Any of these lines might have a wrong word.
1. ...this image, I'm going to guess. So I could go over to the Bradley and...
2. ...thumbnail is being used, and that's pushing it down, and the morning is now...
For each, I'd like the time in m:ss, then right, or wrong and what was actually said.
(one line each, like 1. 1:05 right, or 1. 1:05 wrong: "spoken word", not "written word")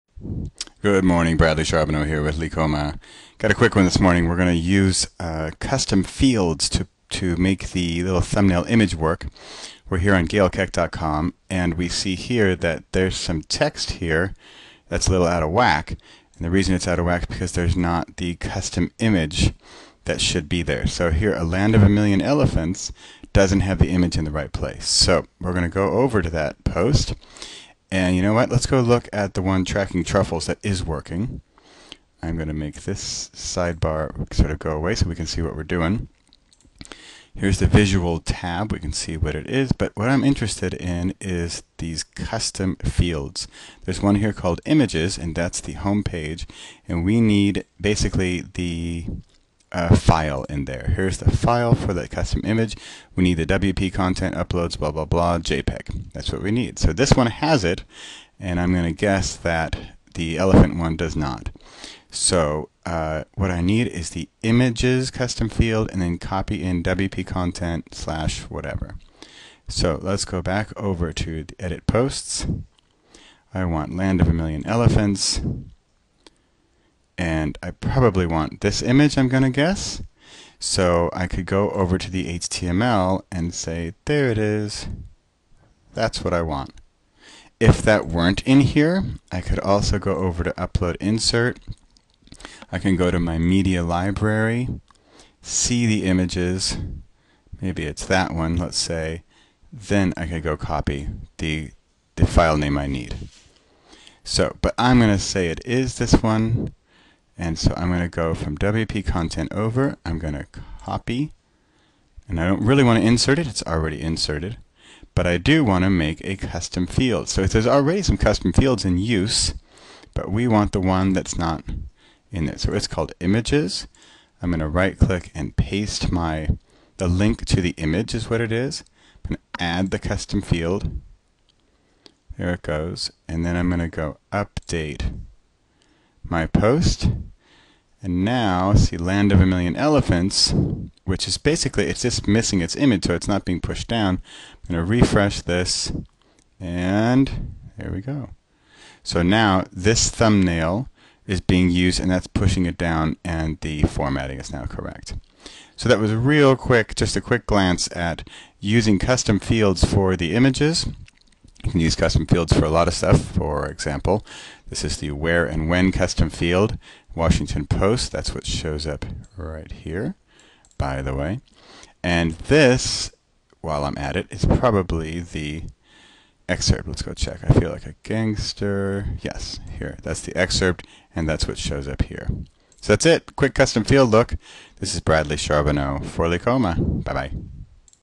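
1. 1:18 wrong: "HTML", not "Bradley"
2. 2:30 wrong: "formatting", not "morning".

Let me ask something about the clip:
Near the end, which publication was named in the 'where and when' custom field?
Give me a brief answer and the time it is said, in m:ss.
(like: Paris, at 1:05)
Washington Post, at 2:47.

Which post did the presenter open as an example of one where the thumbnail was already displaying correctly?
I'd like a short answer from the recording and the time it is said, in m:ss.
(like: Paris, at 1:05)
Tracking Truffles, at 0:29.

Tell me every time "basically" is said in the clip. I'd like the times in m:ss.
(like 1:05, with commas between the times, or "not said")
0:47, 2:21.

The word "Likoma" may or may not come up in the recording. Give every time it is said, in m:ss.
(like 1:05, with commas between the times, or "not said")
0:02, 3:06.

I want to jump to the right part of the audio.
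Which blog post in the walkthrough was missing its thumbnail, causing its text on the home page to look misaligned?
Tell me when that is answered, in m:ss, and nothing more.
0:21.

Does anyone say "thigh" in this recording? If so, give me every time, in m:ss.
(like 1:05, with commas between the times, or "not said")
not said.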